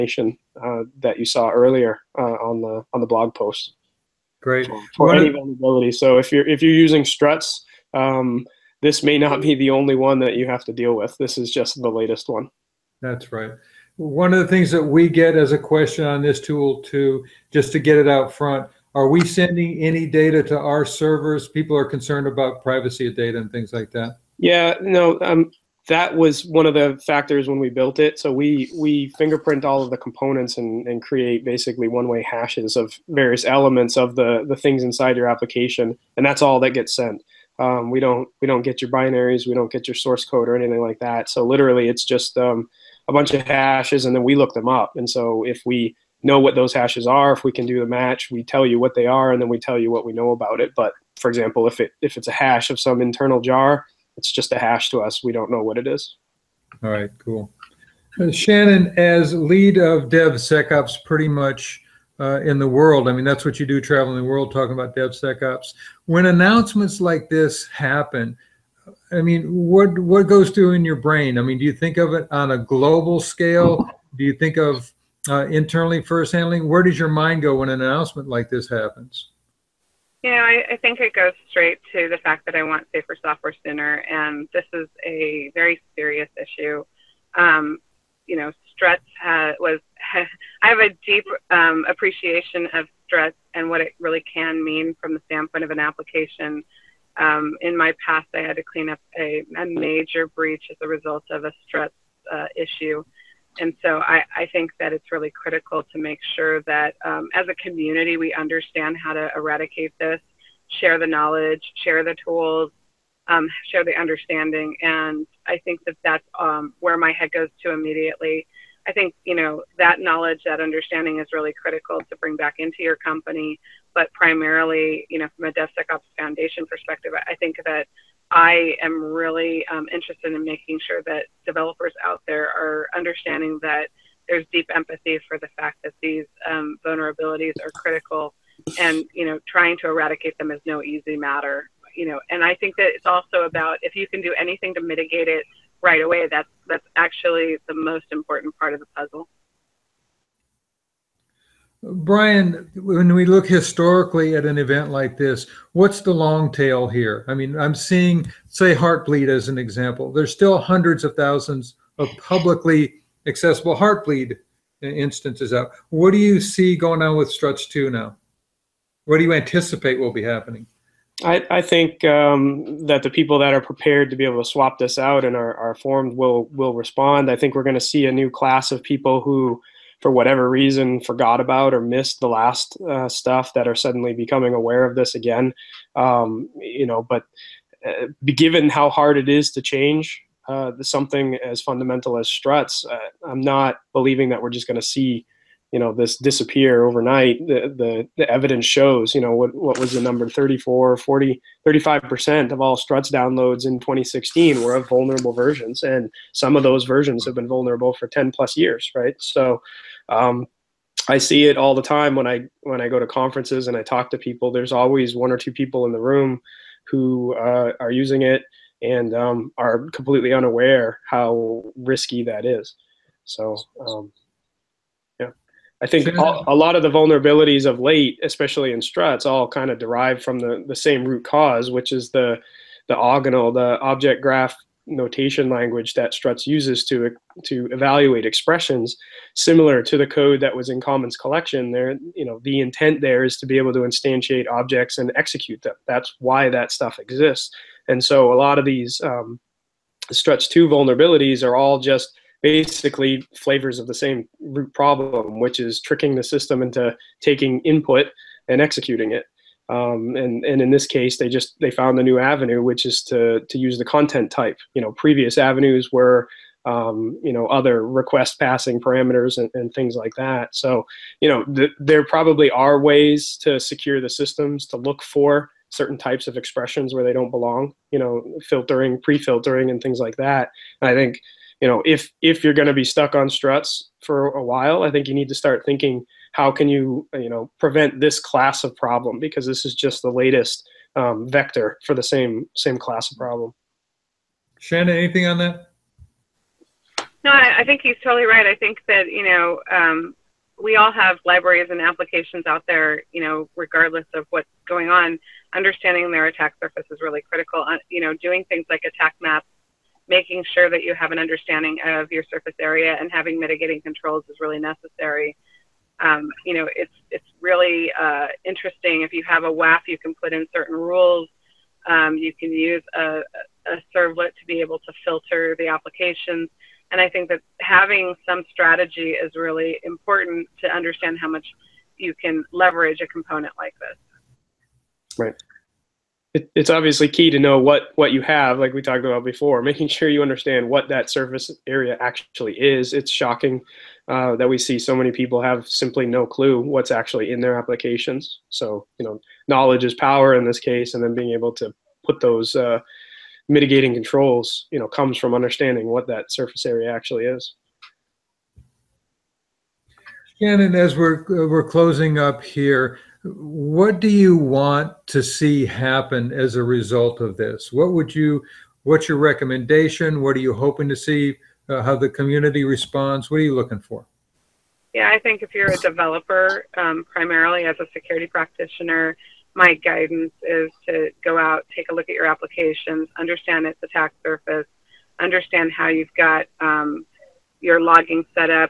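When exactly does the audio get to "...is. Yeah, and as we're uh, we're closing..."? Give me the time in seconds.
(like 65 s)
357 s.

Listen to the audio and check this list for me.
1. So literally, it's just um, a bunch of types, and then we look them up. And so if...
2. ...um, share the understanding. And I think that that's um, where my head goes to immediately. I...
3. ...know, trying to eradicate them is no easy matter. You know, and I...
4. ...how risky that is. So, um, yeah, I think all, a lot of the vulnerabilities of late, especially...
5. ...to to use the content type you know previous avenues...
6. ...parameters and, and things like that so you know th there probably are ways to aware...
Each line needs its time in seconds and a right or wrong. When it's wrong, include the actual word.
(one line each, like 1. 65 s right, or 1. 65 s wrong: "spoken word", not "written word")
1. 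41 s wrong: "hashes", not "types"
2. 113 s right
3. 139 s right
4. 221 s right
5. 263 s right
6. 268 s wrong: "secure", not "aware".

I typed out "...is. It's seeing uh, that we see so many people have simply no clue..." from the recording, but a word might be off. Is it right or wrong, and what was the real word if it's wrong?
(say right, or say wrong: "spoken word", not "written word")
wrong: "shocking", not "seeing".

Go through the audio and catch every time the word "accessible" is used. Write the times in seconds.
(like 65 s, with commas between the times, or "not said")
163 s.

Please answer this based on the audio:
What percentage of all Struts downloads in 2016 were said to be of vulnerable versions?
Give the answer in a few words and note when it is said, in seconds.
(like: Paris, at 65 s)
35%, at 201 s.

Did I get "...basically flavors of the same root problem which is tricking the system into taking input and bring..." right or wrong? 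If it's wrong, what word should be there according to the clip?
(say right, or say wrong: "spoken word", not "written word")
wrong: "executing", not "bring".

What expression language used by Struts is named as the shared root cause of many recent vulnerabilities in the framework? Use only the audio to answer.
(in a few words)
Object graph notation language.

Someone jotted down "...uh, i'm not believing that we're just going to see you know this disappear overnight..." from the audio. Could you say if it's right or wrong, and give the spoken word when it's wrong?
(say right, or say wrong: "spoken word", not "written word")
right.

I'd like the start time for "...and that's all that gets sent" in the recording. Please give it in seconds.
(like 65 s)
36 s.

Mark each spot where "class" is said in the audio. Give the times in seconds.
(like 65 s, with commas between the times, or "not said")
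178 s, 288 s, 292 s.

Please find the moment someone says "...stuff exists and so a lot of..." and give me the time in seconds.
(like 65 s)
246 s.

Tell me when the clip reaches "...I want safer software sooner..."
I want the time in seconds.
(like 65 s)
82 s.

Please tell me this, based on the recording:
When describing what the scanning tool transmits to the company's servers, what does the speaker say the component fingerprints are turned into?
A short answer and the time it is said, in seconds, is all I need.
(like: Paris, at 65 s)
One-way hashes, at 31 s.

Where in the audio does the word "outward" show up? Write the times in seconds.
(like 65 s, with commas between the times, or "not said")
not said.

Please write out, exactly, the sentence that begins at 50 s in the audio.
But for example, if it if it's a hash of some internal jar, it's just a hash to us.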